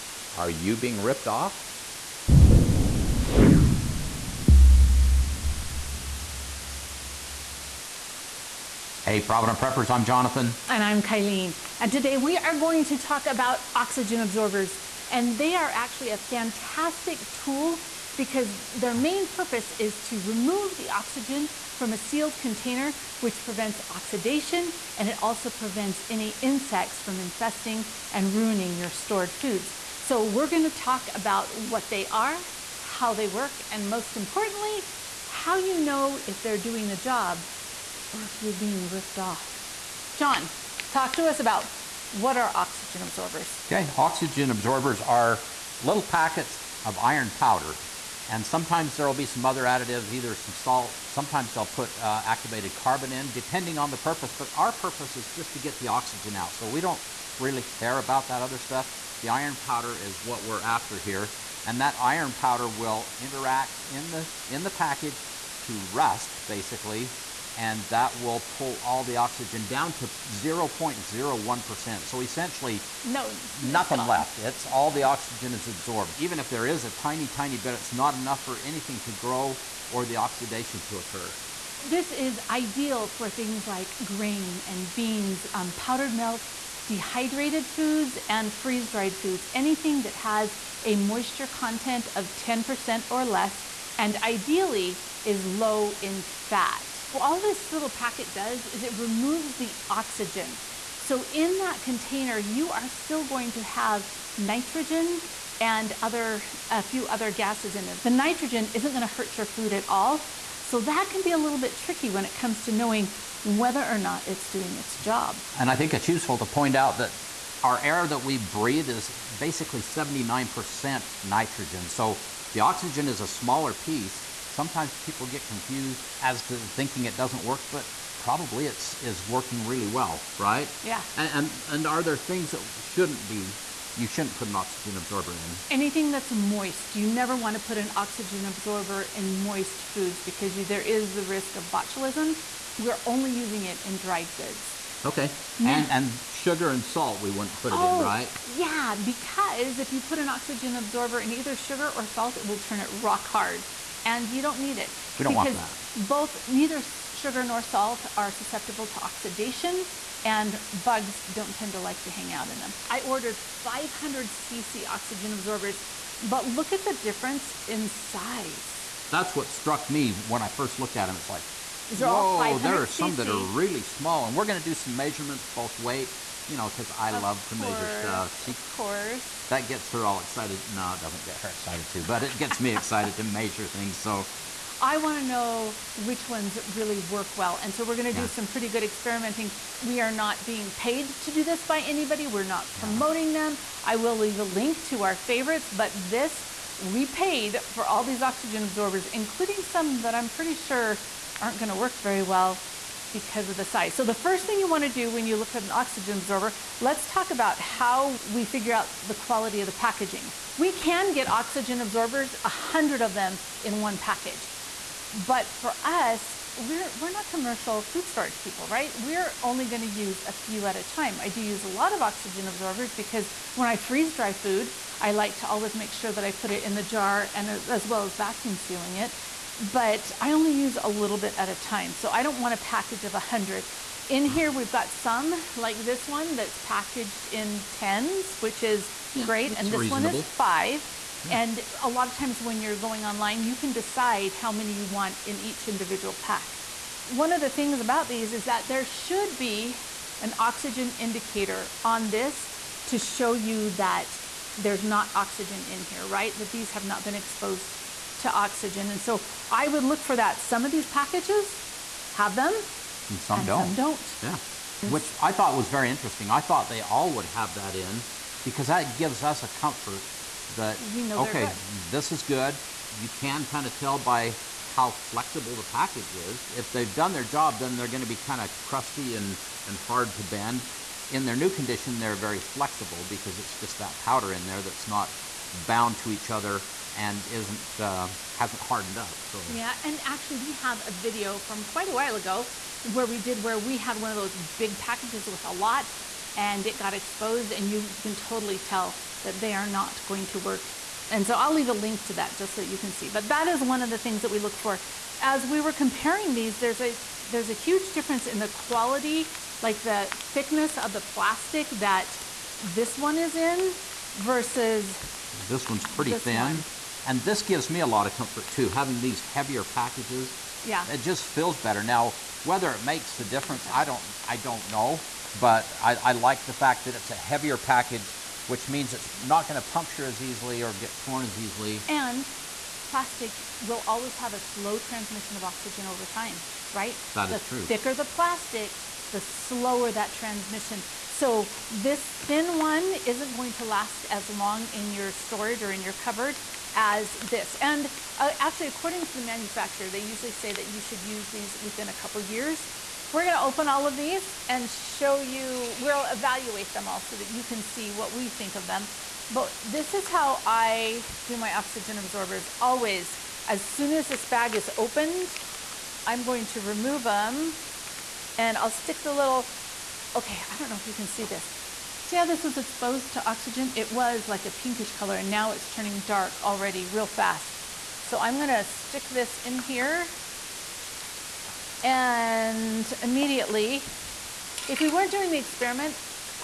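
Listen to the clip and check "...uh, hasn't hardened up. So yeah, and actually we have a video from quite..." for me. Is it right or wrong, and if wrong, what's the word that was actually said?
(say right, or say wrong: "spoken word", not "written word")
right.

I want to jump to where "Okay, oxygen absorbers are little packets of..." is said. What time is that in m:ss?
0:43.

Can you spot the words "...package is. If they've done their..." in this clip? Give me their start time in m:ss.
4:35.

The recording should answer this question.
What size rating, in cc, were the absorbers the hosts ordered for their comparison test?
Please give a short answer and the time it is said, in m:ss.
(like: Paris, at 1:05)
500 cc, at 2:43.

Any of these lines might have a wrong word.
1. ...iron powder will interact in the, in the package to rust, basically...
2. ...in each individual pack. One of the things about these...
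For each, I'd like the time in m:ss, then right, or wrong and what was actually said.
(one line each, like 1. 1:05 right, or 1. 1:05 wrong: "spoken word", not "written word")
1. 1:01 right
2. 4:05 right.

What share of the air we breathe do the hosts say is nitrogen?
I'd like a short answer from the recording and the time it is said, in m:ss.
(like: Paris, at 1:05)
79%, at 1:59.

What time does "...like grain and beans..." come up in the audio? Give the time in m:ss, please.
1:23.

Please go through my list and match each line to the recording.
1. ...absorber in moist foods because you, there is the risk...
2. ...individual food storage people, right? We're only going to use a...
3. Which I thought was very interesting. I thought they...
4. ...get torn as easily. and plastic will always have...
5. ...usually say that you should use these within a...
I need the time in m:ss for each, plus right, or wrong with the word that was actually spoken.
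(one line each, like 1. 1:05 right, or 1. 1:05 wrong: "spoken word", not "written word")
1. 2:18 right
2. 3:37 wrong: "commercial", not "individual"
3. 4:24 right
4. 5:30 right
5. 5:49 right.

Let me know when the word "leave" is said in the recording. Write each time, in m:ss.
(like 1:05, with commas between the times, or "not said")
3:14, 5:01.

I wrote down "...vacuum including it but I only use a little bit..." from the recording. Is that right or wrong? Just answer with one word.
wrong.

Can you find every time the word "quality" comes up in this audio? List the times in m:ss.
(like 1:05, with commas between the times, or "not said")
3:29, 5:08.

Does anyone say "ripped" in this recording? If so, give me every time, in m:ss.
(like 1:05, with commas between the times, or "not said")
0:00, 0:38.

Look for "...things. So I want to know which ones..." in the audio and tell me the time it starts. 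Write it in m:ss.
3:03.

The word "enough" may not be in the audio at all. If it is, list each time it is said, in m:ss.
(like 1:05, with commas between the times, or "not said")
1:18.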